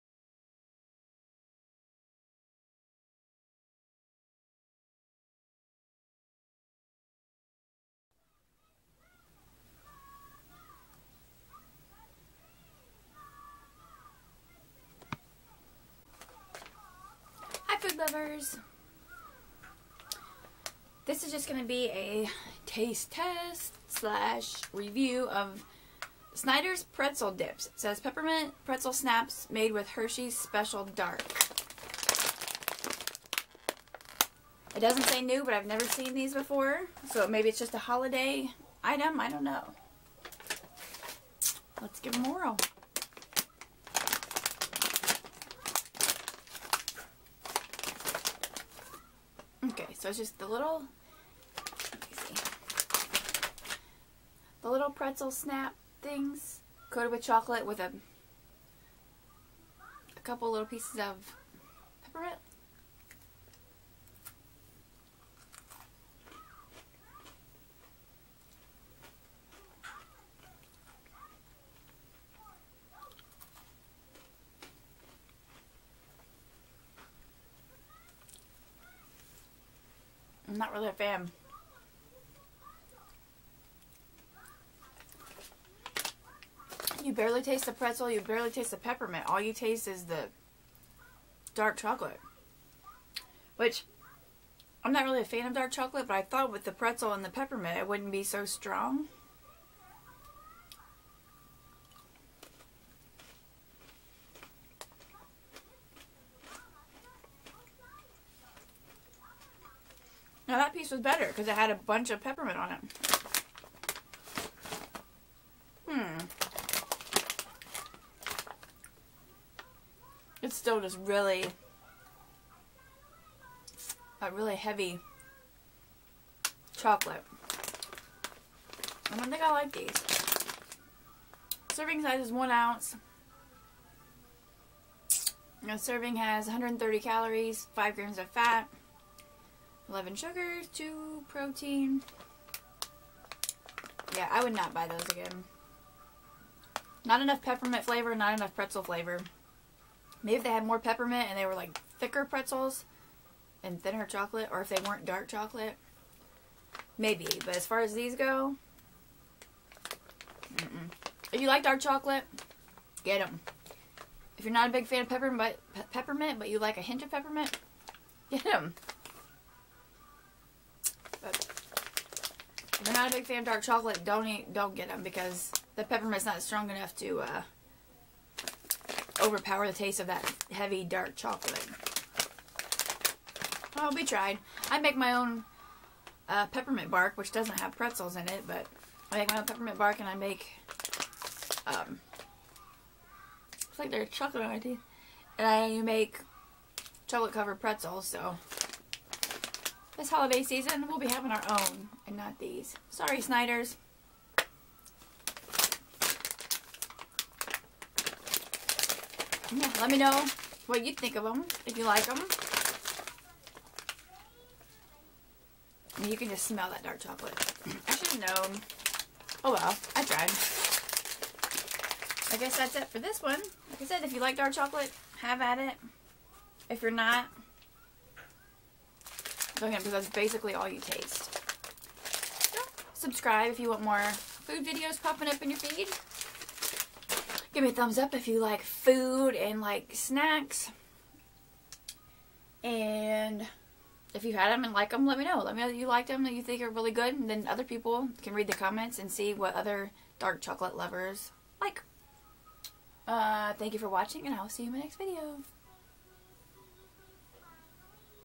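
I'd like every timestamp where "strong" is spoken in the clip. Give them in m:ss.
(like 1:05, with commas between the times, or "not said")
1:38, 2:56.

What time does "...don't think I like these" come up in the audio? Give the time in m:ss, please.
2:09.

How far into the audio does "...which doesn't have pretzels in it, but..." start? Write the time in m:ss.
3:07.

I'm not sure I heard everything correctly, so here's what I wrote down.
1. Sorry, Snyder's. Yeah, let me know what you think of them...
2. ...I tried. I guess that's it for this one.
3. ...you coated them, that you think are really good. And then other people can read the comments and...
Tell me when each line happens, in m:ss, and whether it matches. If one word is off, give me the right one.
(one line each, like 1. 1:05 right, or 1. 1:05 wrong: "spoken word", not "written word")
1. 3:22 right
2. 3:39 right
3. 4:05 wrong: "liked", not "coated".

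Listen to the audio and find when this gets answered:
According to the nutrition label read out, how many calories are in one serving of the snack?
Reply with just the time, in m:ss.
2:16.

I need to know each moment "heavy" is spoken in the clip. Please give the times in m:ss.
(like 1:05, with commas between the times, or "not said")
2:04, 3:00.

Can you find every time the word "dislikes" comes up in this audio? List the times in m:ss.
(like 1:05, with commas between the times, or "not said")
not said.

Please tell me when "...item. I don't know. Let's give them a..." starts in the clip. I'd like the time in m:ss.
0:38.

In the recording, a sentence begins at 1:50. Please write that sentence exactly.
piece was better because it had a bunch of peppermint on it.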